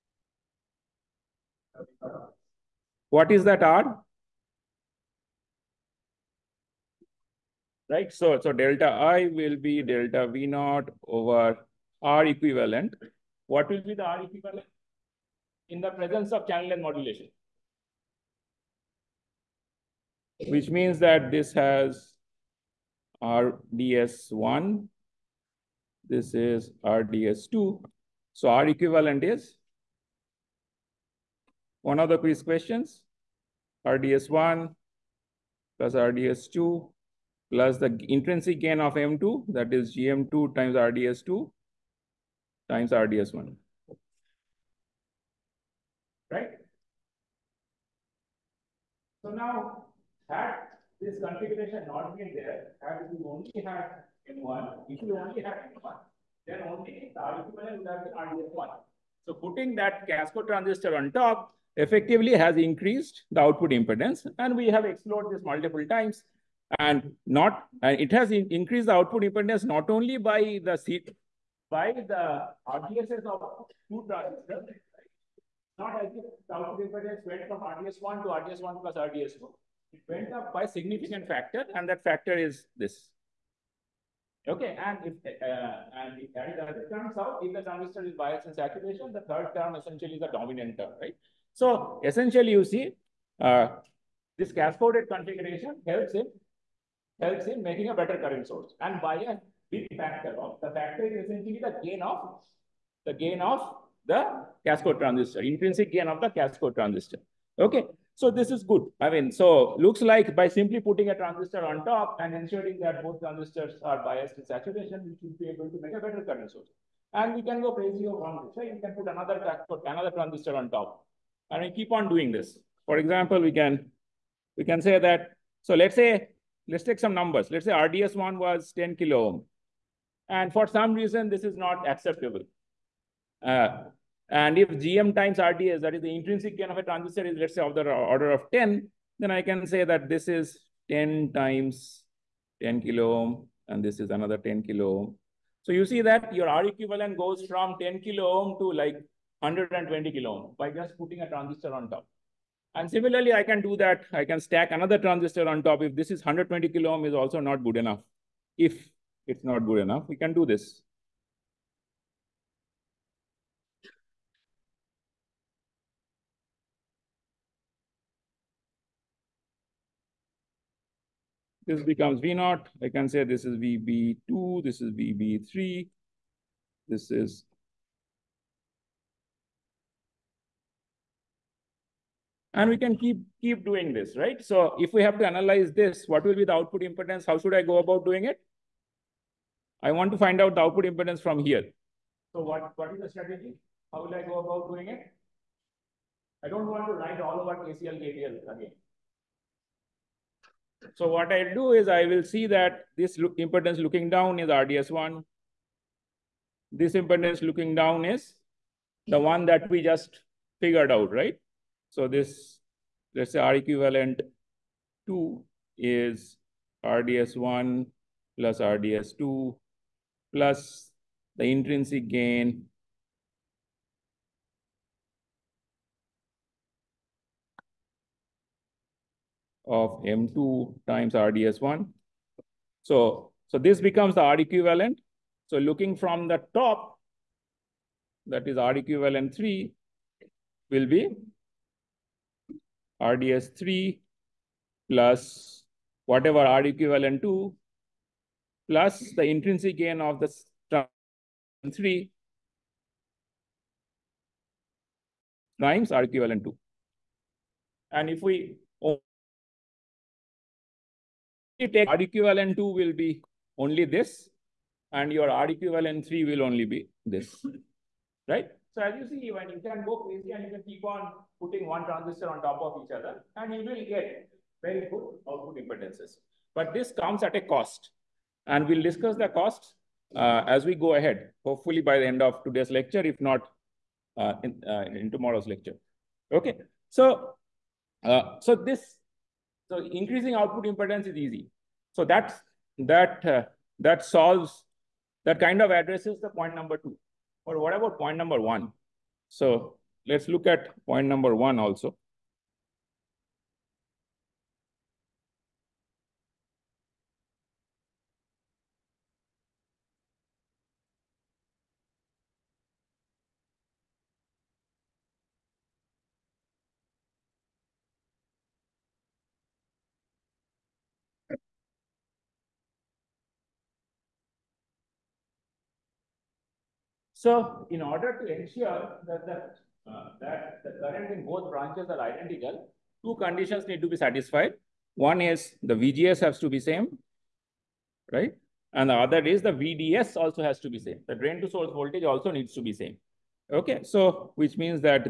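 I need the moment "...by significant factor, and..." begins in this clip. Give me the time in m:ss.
1:20.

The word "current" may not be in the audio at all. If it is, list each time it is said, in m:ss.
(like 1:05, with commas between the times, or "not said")
1:38, 1:56, 5:30.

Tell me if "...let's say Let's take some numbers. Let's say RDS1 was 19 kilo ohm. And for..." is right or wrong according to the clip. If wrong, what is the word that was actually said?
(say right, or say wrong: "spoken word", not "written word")
wrong: "10", not "19".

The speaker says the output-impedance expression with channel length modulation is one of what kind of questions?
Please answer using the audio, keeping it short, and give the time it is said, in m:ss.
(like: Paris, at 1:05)
quiz questions, at 0:32.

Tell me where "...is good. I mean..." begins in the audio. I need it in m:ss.
1:48.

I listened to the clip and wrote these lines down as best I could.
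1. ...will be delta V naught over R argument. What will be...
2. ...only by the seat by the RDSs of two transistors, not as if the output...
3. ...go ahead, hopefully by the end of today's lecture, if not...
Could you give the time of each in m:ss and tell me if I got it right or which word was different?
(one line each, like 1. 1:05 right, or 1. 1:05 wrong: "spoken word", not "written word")
1. 0:09 wrong: "equivalent", not "argument"
2. 1:09 right
3. 4:40 right.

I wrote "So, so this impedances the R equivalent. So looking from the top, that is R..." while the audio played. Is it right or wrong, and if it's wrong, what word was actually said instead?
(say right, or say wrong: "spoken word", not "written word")
wrong: "becomes", not "impedances".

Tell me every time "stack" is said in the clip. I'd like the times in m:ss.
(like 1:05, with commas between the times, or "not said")
2:34.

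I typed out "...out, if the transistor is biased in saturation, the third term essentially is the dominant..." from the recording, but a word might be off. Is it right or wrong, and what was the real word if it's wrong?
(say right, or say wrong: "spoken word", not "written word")
right.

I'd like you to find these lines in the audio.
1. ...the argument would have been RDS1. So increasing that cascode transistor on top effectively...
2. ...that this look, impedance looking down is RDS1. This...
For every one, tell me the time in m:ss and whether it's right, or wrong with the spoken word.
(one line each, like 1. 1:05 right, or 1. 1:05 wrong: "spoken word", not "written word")
1. 0:57 wrong: "putting", not "increasing"
2. 3:22 right.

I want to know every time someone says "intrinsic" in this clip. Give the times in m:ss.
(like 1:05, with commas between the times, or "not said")
0:38, 1:45, 2:16, 3:41, 4:09.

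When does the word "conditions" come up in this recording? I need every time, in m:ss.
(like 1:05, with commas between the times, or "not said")
5:33.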